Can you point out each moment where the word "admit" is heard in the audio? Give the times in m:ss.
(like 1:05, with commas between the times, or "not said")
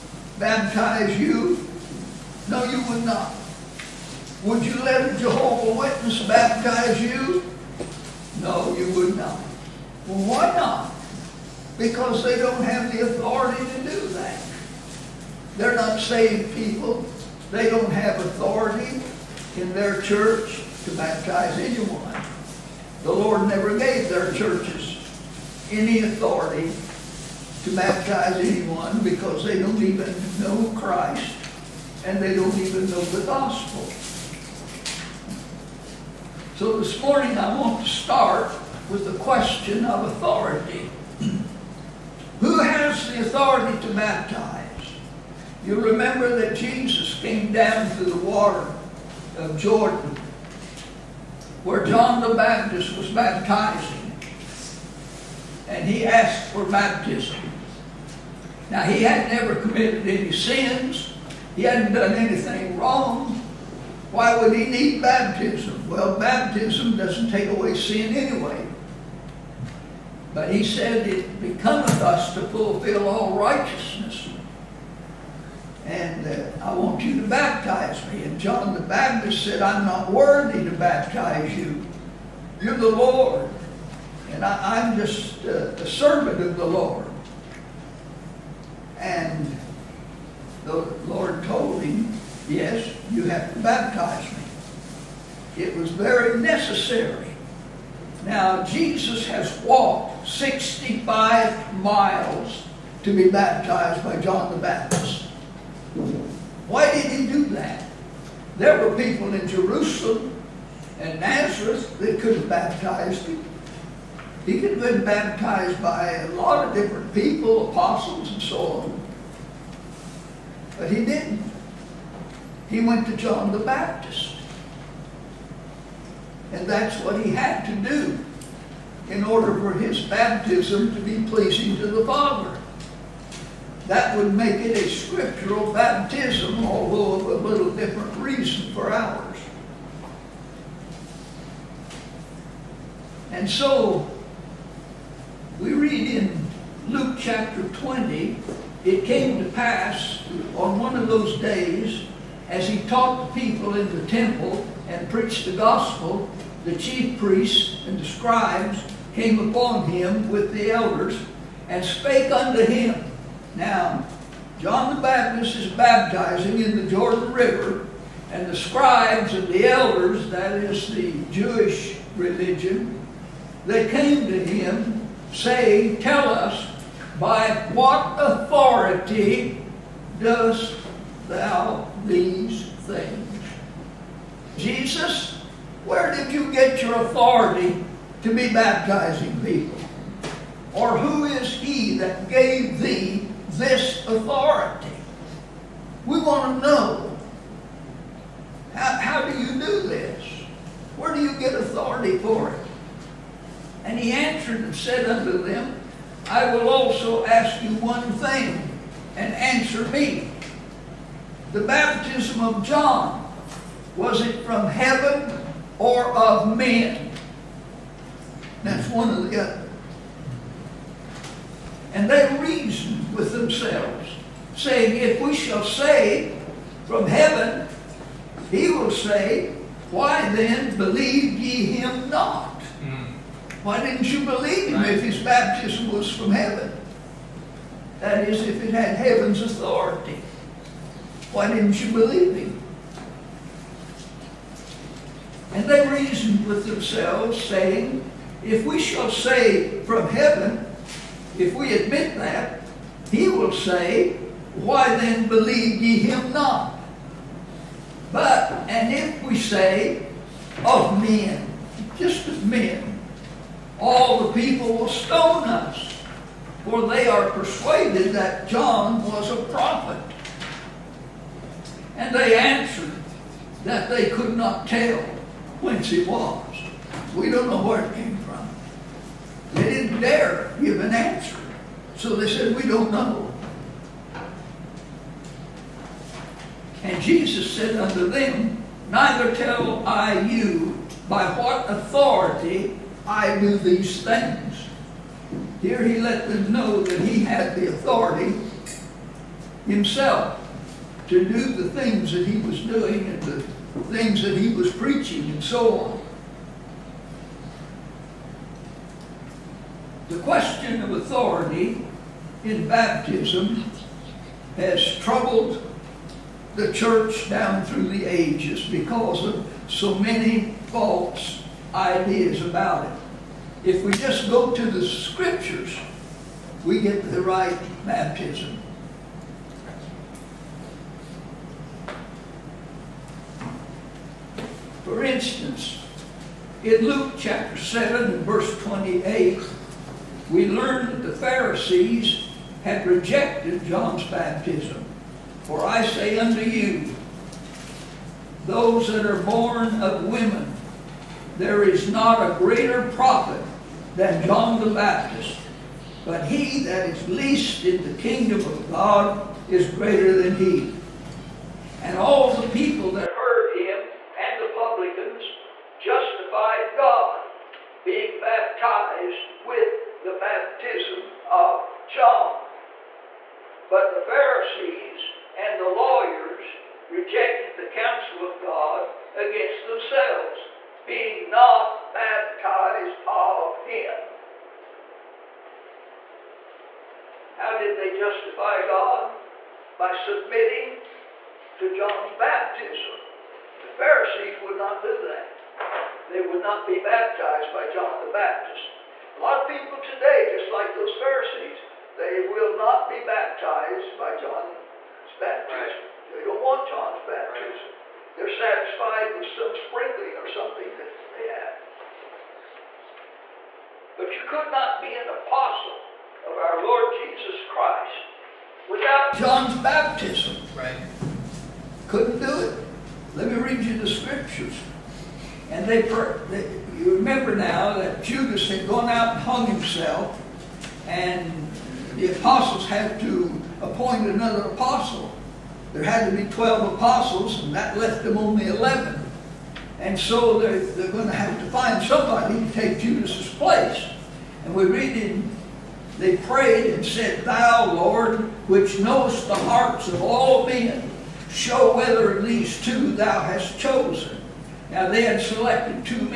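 4:11.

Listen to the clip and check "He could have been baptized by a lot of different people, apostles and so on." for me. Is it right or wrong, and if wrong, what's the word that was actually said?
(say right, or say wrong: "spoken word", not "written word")
right.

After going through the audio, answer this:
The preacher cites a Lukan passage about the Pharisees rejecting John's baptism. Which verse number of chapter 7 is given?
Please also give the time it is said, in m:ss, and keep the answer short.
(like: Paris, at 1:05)
28, at 5:38.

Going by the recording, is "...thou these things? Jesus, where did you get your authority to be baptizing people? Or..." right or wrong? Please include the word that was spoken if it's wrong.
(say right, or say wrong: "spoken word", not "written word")
right.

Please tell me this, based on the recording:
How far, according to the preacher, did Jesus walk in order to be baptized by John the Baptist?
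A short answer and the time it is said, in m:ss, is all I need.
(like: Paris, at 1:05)
65 miles, at 1:40.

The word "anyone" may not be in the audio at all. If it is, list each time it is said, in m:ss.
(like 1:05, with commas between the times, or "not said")
0:21, 0:28.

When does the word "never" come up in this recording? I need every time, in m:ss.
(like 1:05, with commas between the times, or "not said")
0:23, 0:59.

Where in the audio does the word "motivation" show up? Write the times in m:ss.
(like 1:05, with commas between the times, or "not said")
not said.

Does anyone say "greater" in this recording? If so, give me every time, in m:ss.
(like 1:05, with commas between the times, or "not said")
5:52, 5:59.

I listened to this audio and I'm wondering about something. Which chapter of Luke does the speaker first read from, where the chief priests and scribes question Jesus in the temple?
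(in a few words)
Luke chapter 20.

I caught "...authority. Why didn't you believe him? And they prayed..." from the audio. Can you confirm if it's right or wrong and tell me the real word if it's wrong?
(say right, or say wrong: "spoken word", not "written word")
wrong: "reasoned", not "prayed".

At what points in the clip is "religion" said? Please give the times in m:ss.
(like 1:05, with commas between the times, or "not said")
2:52.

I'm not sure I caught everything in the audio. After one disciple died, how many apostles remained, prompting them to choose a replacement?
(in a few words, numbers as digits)
11.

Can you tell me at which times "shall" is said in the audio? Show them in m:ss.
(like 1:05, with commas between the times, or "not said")
3:45, 4:08.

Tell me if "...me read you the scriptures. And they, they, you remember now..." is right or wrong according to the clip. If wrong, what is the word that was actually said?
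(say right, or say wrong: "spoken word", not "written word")
right.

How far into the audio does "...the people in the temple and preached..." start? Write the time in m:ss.
2:33.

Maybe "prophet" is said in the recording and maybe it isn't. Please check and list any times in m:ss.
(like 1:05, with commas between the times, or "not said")
4:29, 5:52.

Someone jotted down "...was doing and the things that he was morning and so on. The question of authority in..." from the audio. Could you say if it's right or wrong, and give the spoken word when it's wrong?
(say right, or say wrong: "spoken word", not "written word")
wrong: "preaching", not "morning".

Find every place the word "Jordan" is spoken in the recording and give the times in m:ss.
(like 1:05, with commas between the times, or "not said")
0:49, 2:46.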